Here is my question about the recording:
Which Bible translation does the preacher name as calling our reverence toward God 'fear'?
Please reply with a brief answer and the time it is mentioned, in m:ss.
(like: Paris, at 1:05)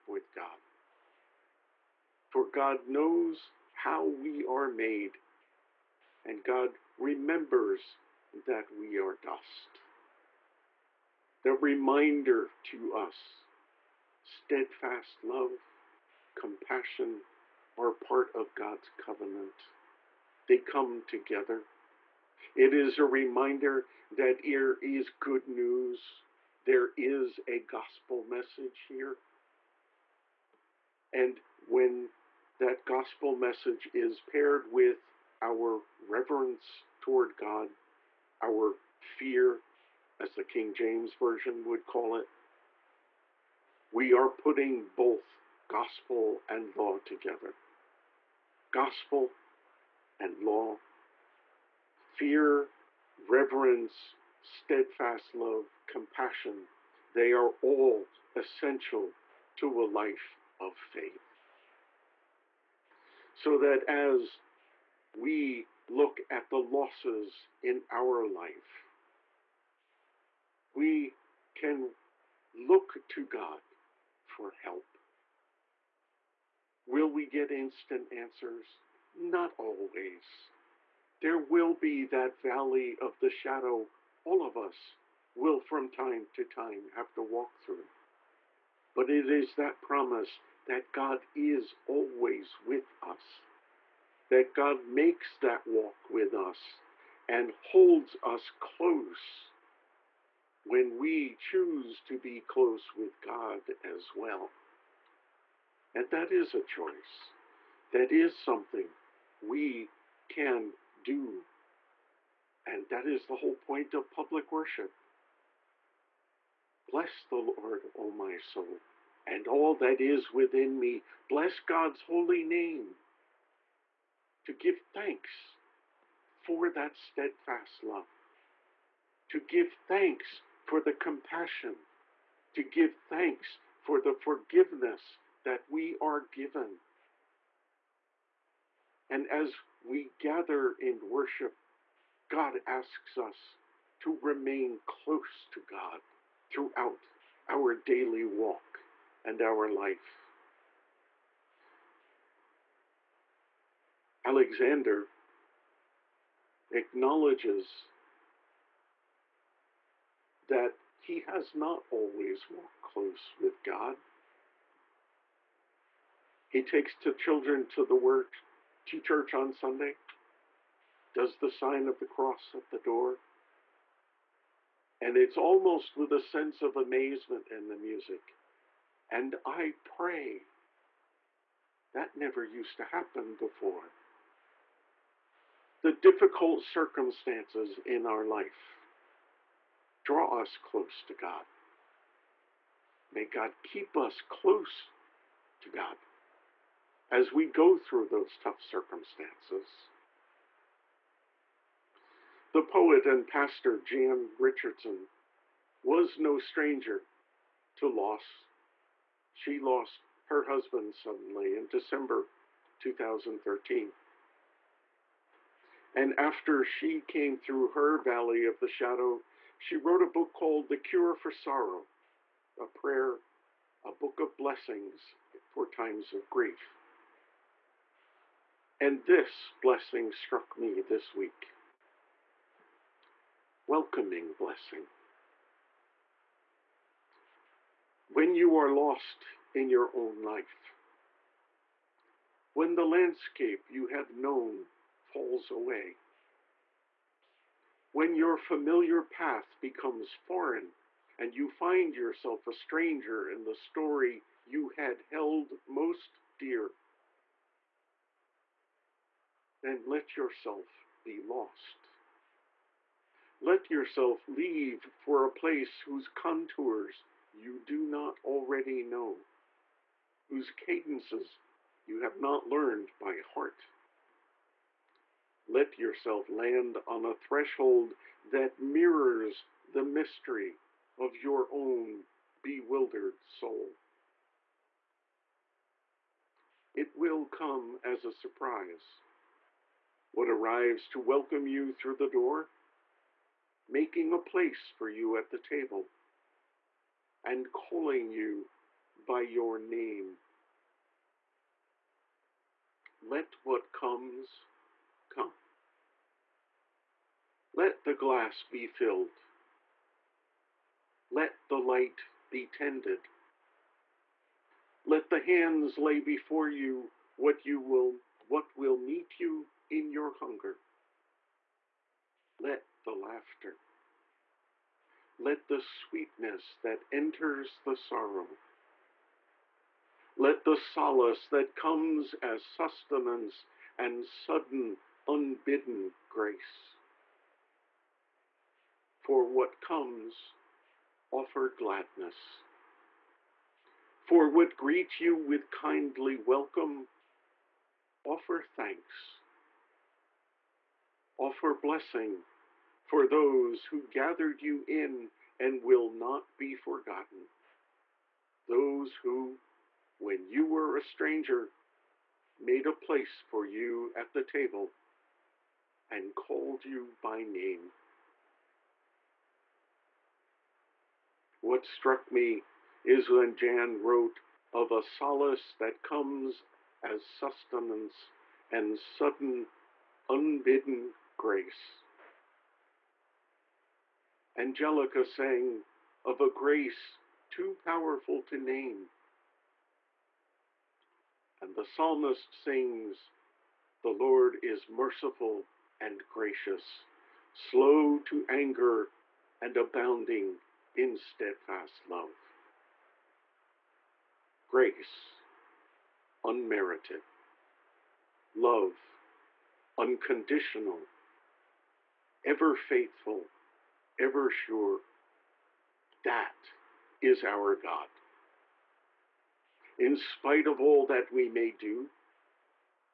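King James Version, at 0:40.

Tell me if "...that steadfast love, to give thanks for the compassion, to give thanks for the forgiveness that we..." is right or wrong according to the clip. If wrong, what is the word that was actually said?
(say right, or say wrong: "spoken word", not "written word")
right.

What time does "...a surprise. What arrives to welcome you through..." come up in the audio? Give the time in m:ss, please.
4:48.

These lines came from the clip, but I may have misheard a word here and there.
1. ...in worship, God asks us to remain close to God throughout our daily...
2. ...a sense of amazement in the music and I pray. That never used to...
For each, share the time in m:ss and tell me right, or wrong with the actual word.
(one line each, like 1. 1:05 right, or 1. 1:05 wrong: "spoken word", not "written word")
1. 2:20 right
2. 2:56 right.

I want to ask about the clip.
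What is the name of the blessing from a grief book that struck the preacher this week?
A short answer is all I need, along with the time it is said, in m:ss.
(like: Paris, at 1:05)
Welcoming Blessing, at 3:53.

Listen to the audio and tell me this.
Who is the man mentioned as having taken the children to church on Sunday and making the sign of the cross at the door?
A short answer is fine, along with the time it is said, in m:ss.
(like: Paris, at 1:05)
Alexander, at 2:34.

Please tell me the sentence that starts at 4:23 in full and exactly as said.
Let yourself leave for a place whose contours you do not already know, whose cadences you have not learned by heart.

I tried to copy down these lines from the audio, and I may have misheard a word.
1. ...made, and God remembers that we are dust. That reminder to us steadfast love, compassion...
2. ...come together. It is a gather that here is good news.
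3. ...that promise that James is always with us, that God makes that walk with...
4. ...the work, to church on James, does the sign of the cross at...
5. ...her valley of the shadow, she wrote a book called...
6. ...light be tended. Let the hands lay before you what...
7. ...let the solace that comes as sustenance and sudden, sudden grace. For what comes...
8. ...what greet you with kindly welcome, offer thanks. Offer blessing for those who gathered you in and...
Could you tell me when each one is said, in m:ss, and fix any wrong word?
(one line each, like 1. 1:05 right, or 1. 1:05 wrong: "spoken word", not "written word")
1. 0:04 right
2. 0:20 wrong: "reminder", not "gather"
3. 1:29 wrong: "God", not "James"
4. 2:47 wrong: "Sunday", not "James"
5. 3:37 right
6. 5:11 right
7. 5:30 wrong: "unbidden", not "sudden"
8. 5:44 right.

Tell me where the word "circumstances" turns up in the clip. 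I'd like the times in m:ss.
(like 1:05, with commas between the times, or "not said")
3:06, 3:18.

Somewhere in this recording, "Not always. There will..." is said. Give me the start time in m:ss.
1:19.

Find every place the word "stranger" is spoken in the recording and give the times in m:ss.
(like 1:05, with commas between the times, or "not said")
3:26, 4:12, 6:00.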